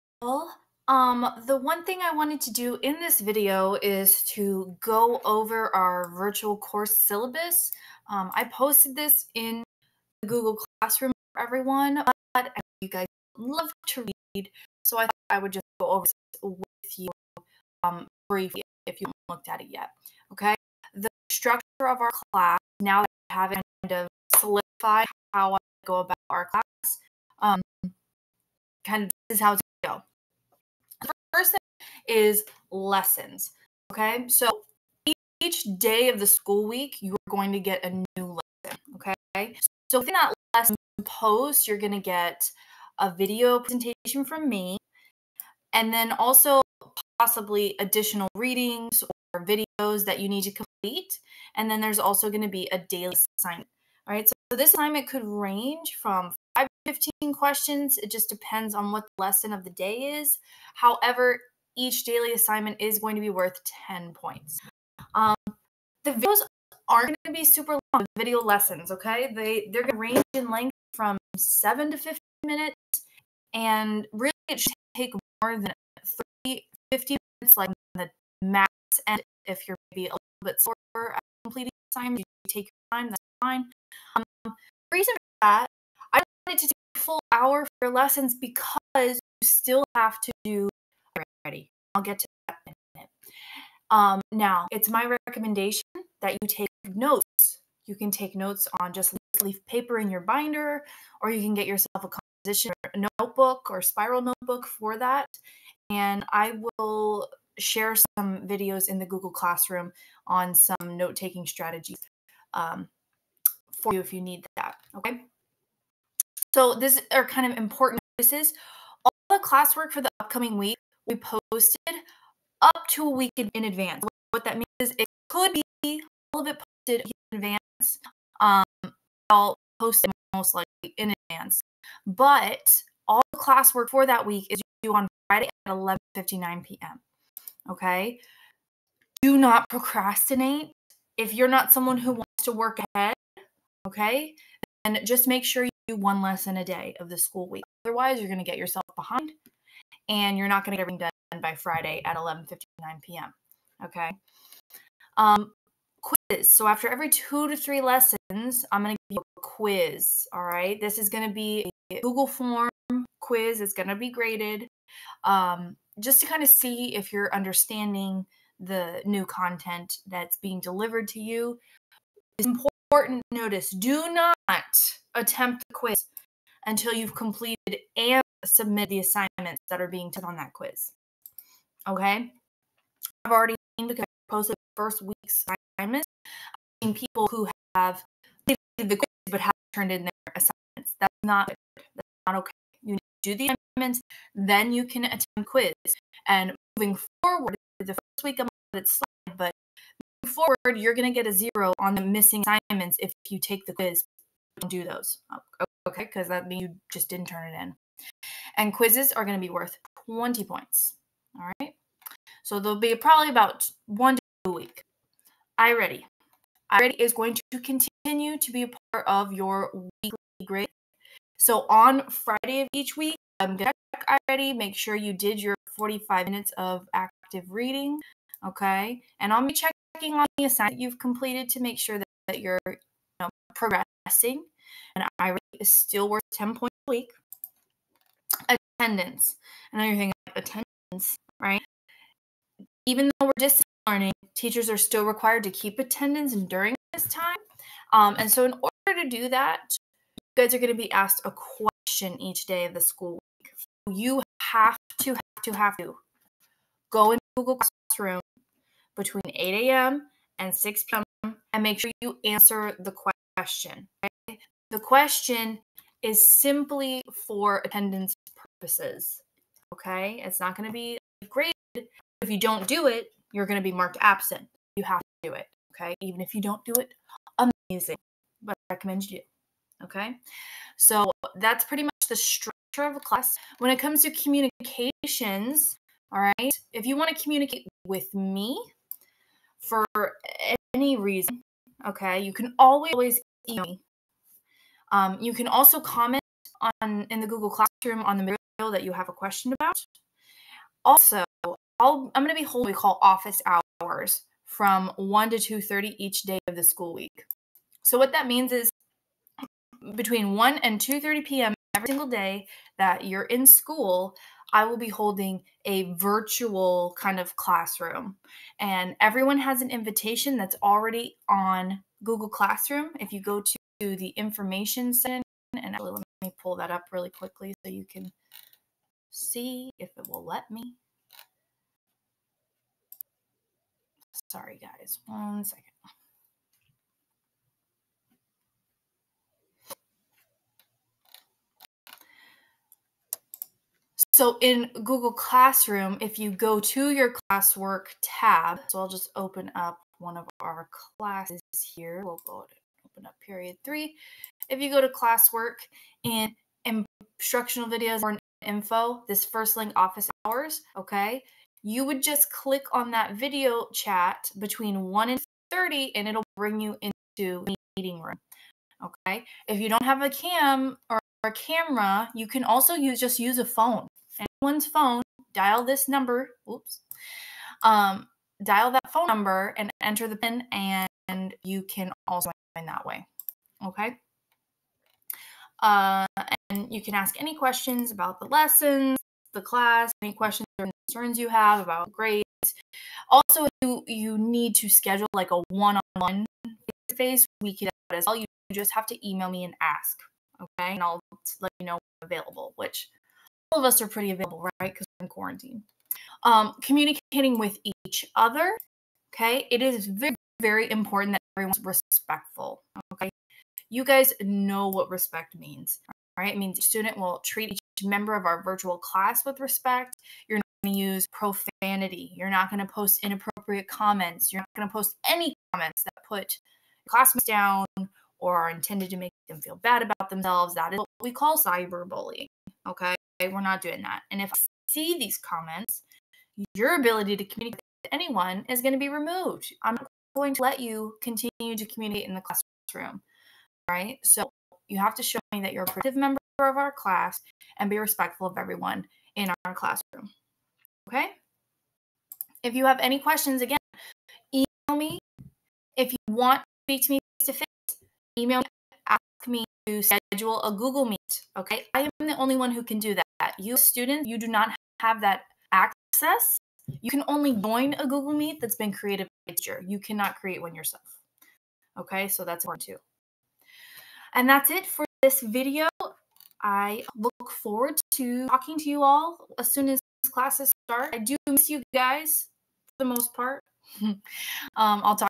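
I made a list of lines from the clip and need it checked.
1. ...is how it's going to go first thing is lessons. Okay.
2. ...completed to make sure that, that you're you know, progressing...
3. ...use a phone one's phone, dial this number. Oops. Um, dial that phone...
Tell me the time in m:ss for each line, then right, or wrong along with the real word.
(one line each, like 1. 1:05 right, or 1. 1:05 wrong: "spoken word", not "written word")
1. 0:29 right
2. 3:50 right
3. 6:13 right.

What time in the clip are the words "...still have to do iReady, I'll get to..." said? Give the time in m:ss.
1:29.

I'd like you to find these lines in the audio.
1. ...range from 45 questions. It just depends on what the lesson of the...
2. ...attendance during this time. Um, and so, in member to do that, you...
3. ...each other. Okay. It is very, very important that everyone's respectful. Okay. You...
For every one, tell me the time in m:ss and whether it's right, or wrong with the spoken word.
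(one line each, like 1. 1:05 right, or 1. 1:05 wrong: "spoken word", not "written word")
1. 0:55 wrong: "15", not "45"
2. 4:05 wrong: "order", not "member"
3. 6:47 right.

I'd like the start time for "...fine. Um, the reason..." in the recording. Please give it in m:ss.
1:23.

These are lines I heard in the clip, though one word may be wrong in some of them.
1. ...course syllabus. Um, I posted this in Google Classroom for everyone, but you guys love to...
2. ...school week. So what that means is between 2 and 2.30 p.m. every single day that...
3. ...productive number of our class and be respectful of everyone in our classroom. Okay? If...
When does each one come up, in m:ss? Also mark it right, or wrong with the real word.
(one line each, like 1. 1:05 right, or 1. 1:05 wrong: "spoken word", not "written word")
1. 0:06 right
2. 5:06 wrong: "1", not "2"
3. 7:25 wrong: "member", not "number".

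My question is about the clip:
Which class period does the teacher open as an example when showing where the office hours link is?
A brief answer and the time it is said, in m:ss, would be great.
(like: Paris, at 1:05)
Period 3, at 5:53.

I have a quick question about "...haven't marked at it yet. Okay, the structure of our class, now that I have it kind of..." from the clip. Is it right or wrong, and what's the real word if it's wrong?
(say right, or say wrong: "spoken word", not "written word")
wrong: "looked", not "marked".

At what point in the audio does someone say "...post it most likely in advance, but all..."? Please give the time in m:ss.
2:09.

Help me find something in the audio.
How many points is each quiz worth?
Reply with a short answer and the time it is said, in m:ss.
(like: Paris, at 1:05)
20, at 3:30.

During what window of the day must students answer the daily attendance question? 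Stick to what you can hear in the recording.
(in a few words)
8 a.m. to 6 p.m.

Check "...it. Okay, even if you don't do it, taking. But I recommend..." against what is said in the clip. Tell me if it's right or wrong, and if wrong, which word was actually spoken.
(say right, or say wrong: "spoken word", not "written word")
wrong: "amazing", not "taking".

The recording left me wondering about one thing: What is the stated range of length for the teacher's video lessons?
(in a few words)
7 to 15 minutes.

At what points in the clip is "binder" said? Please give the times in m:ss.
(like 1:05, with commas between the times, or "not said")
1:40.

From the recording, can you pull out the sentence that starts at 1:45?
And I will share some videos in the Google Classroom on some note taking strategies um, for you if you need that.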